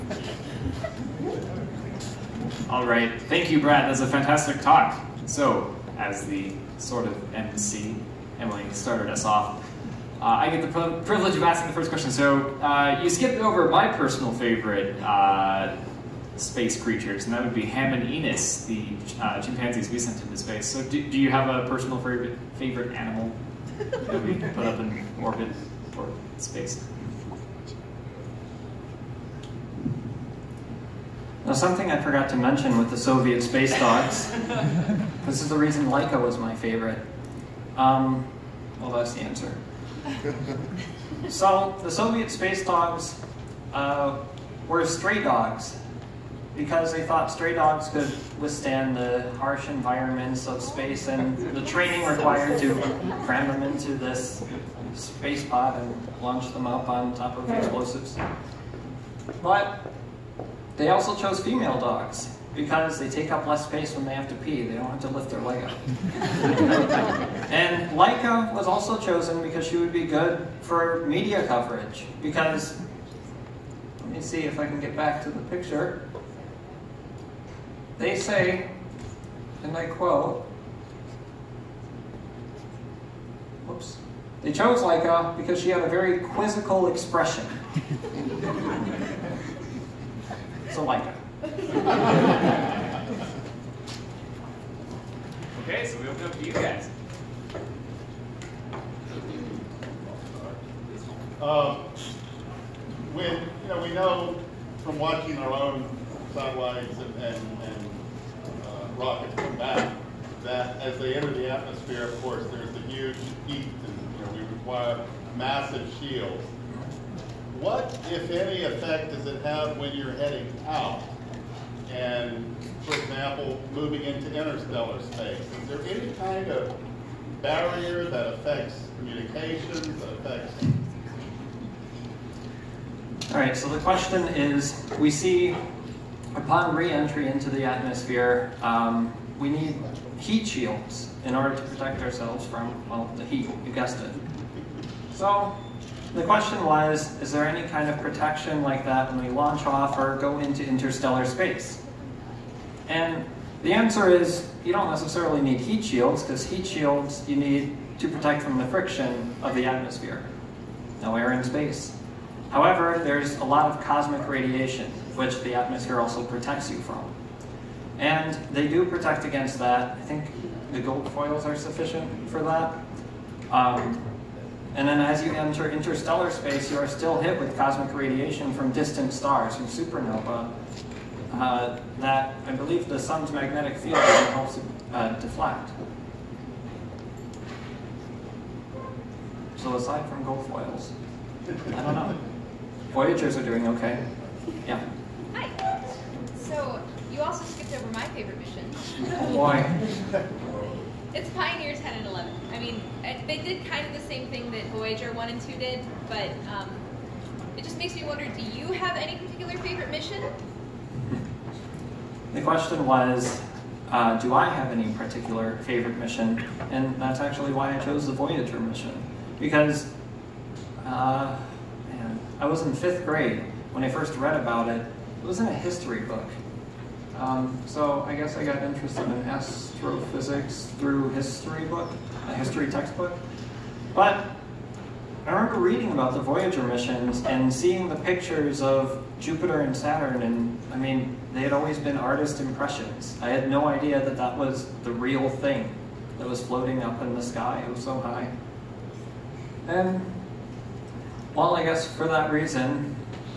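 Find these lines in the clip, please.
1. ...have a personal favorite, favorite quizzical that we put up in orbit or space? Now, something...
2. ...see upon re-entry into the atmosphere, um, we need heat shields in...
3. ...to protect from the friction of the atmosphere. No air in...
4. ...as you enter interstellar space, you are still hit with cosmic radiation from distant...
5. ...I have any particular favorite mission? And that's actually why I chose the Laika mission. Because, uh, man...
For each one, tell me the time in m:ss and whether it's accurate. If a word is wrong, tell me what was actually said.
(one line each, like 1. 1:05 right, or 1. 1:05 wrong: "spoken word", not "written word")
1. 0:21 wrong: "animal", not "quizzical"
2. 2:15 right
3. 2:37 right
4. 2:55 right
5. 3:34 wrong: "Voyager", not "Laika".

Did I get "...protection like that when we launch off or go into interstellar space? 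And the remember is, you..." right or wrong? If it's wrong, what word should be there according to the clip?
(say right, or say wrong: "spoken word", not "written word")
wrong: "answer", not "remember".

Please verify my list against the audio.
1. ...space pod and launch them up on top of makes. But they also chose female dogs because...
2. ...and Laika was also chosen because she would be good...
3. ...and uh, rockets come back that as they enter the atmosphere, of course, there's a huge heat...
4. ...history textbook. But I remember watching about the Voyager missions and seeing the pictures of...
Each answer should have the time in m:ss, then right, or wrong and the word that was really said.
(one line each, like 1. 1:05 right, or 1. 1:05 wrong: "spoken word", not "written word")
1. 0:54 wrong: "explosives", not "makes"
2. 1:07 right
3. 1:47 right
4. 3:52 wrong: "reading", not "watching".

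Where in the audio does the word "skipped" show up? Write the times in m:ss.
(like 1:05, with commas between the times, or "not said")
0:13, 3:17.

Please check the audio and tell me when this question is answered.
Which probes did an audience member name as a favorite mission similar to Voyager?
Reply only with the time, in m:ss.
3:21.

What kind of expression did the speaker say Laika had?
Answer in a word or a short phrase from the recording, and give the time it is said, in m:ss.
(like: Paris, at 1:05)
Quizzical, at 1:26.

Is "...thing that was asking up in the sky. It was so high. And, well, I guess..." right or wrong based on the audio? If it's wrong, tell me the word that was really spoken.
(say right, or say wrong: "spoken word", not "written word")
wrong: "floating", not "asking".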